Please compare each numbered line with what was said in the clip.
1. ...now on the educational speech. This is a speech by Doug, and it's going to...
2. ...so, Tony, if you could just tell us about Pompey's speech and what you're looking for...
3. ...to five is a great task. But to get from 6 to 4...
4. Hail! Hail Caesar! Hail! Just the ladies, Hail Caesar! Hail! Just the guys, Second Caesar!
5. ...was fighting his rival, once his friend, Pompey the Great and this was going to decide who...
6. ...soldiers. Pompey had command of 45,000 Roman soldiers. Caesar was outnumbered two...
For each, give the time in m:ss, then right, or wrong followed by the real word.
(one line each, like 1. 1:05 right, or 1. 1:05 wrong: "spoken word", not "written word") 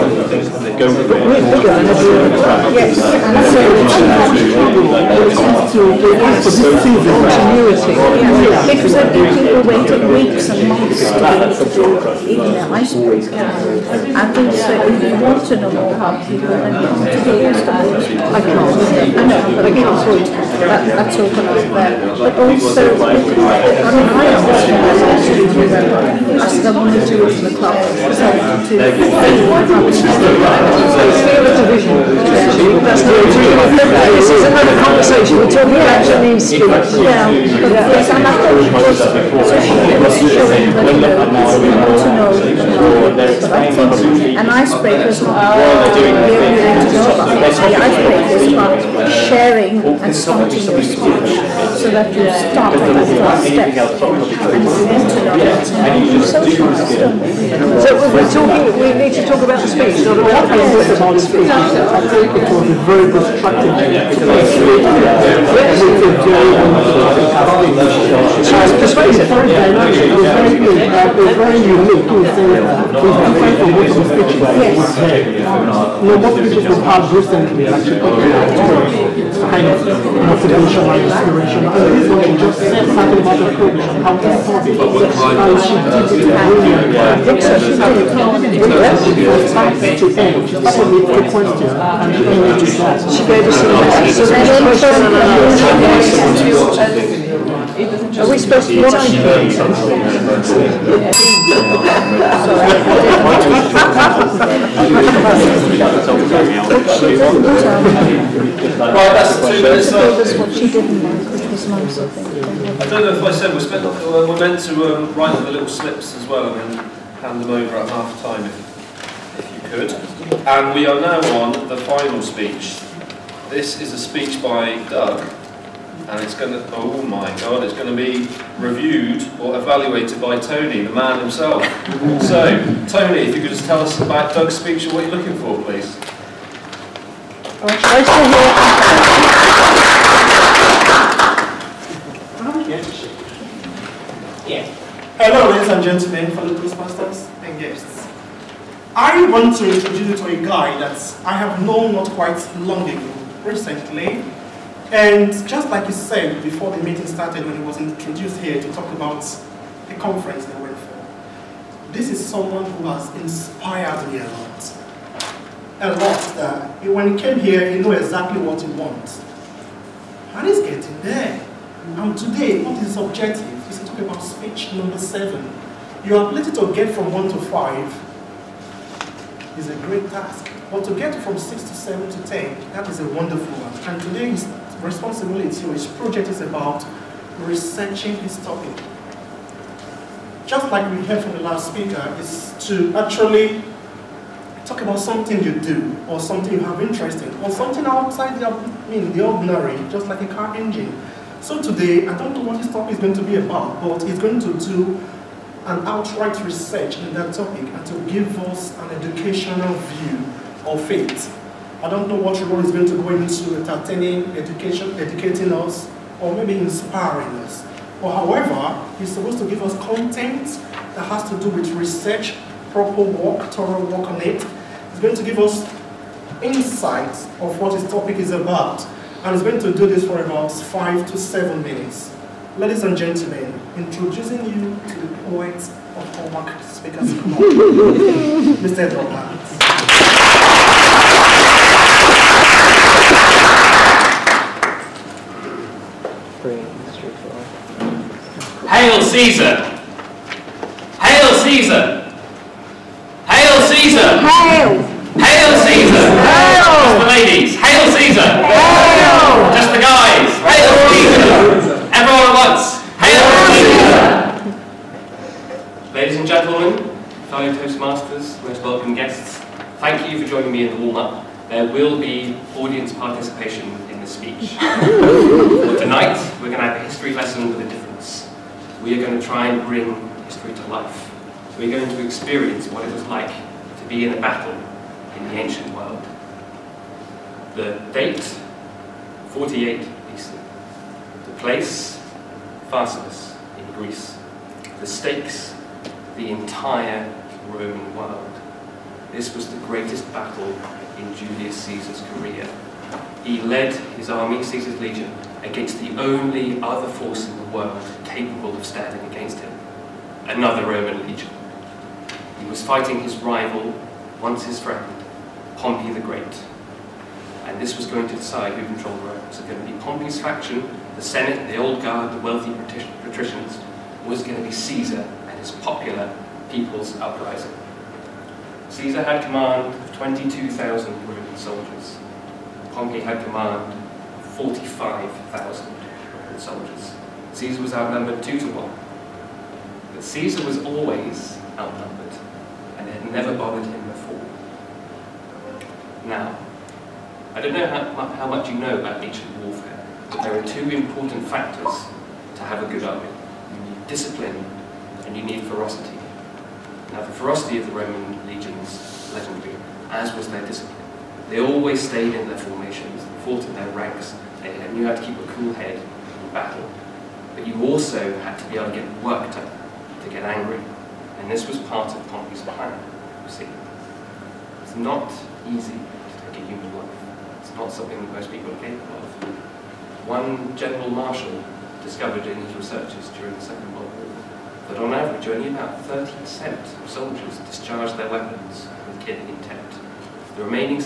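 1. 2:00 wrong: "final", not "educational"
2. 2:12 wrong: "Doug", not "Pompey"
3. 2:57 wrong: "7", not "4"
4. 4:14 wrong: "Hail", not "Second"
5. 5:12 right
6. 5:31 right.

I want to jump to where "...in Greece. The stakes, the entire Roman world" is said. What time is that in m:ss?
4:53.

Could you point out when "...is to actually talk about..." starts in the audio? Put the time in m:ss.
3:12.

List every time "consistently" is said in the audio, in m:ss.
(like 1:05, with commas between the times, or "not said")
not said.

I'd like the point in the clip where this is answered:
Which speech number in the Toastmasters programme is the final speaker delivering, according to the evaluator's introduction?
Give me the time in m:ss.
2:54.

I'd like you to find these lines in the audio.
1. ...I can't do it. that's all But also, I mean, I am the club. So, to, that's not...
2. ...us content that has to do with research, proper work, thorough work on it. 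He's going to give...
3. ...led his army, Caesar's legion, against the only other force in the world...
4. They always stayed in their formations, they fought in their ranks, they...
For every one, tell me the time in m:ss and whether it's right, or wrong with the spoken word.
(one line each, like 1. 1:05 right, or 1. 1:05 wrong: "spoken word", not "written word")
1. 0:19 right
2. 3:39 right
3. 5:03 right
4. 6:01 right.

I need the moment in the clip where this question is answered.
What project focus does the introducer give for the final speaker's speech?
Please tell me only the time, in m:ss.
3:07.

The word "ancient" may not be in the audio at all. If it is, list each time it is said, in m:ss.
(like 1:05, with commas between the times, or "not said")
4:45, 5:49.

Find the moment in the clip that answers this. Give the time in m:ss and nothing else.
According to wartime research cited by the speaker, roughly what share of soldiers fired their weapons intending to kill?
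6:25.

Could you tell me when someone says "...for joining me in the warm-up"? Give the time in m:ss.
4:30.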